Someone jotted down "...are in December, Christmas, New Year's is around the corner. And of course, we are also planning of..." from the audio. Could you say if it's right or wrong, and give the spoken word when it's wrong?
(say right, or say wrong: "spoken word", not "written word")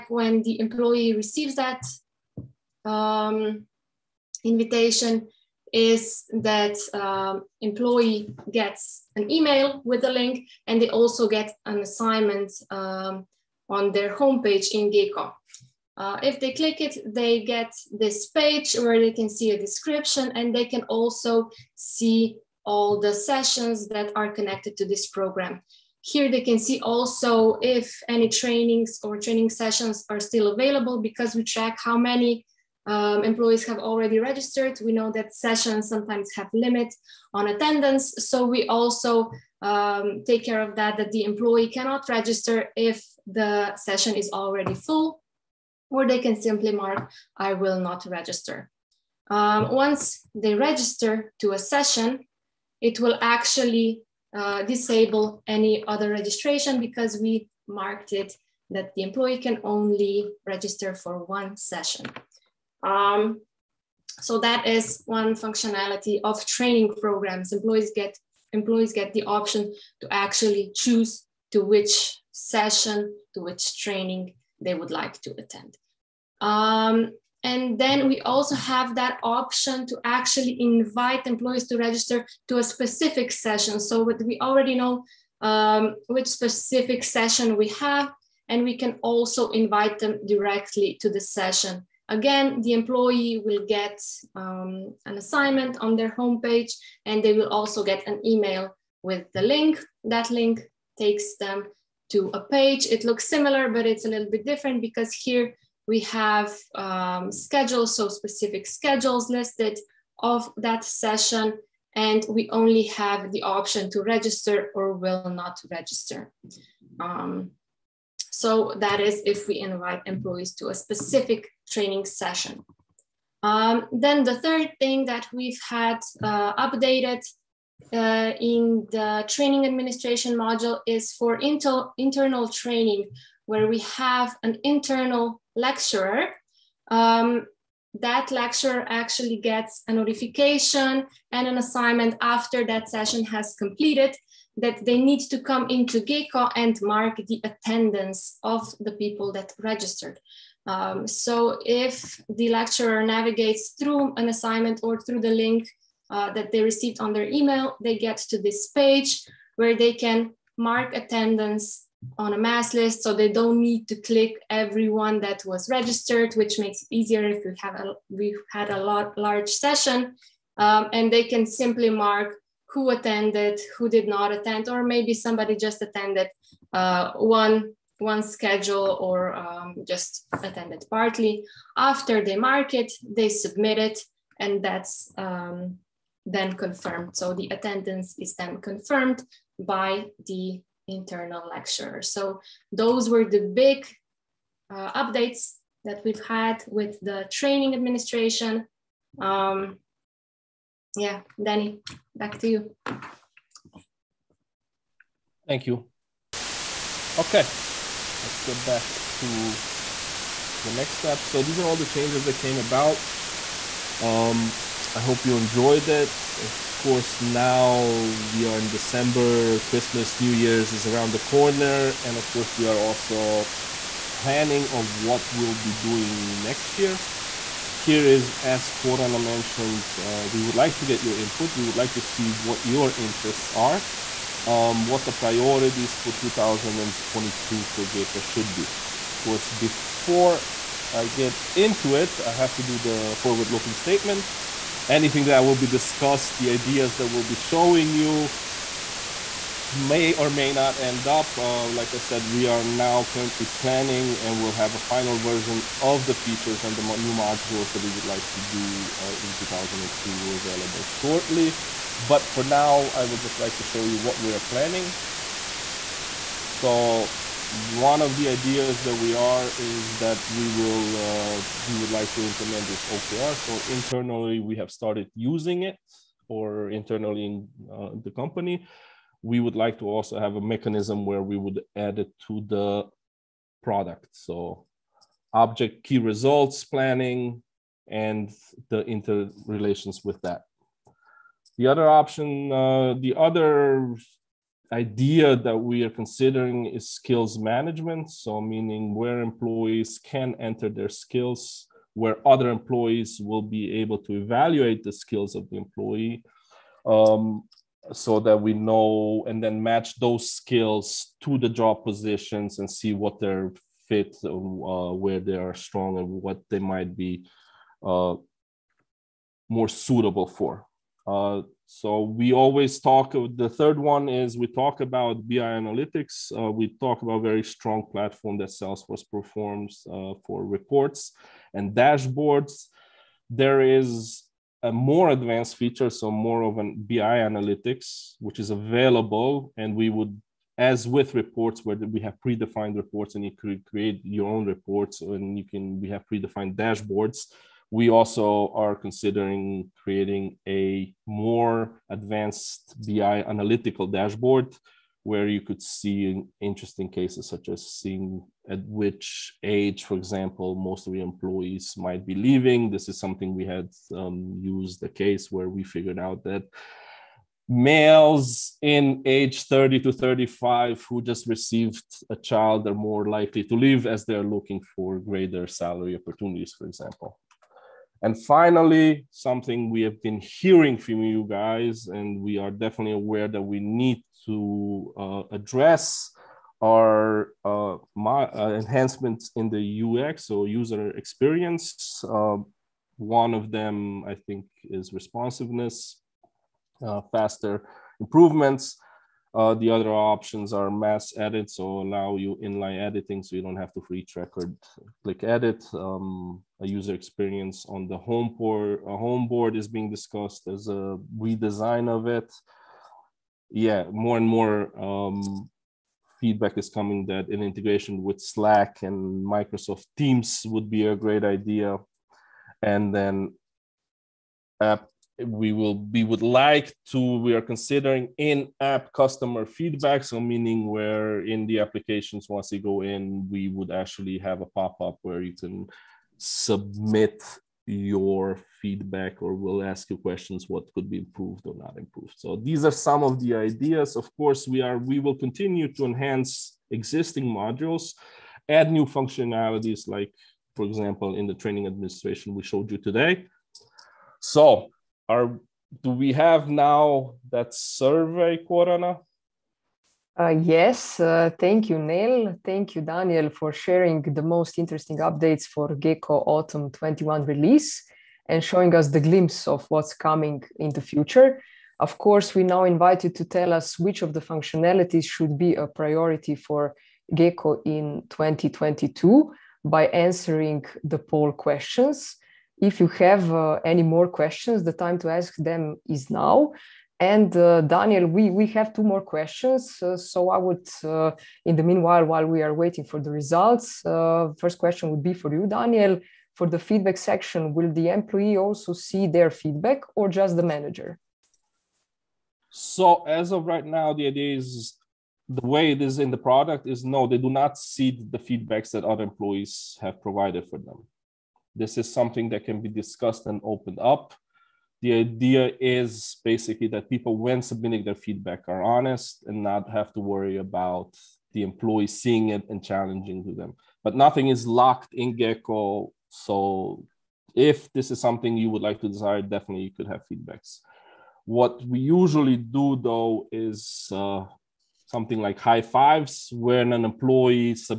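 right.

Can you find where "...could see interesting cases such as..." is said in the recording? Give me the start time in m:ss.
5:55.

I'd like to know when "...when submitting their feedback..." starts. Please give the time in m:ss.
8:37.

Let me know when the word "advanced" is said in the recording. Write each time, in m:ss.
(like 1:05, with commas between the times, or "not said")
5:35, 5:51.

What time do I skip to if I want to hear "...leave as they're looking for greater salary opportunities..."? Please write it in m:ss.
6:13.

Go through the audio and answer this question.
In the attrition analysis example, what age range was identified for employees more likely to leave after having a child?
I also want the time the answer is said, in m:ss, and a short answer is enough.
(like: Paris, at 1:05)
30 to 35, at 6:09.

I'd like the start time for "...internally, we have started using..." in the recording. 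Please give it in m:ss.
4:33.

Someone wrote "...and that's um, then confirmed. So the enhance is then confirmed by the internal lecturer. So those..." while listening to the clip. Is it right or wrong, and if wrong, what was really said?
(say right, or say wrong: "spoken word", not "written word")
wrong: "attendance", not "enhance".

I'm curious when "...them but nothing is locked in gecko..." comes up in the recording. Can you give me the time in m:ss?
8:43.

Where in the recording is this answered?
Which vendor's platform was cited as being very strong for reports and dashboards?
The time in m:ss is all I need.
5:28.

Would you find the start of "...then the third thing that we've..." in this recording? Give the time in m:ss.
2:03.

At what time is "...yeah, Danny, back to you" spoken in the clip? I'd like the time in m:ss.
3:20.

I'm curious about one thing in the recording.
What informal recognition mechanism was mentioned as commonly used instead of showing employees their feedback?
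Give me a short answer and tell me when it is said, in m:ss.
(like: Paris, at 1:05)
High fives, at 8:55.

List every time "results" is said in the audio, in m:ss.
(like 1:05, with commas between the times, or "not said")
4:45, 8:13.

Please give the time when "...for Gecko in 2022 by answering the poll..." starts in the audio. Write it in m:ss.
7:56.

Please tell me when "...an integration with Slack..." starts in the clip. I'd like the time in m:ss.
6:57.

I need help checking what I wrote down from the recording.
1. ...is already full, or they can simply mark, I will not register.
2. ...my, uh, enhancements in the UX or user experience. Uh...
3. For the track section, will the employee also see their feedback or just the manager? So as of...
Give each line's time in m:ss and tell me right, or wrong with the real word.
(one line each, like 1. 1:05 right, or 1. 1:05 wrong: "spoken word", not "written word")
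1. 0:44 right
2. 6:27 right
3. 8:16 wrong: "feedback", not "track".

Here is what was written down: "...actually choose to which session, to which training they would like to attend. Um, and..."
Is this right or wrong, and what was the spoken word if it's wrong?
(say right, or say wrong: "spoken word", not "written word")
right.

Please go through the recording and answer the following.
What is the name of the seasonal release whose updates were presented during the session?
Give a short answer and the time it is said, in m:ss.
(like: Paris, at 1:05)
Autumn 21, at 7:46.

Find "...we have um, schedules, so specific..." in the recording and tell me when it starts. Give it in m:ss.
1:45.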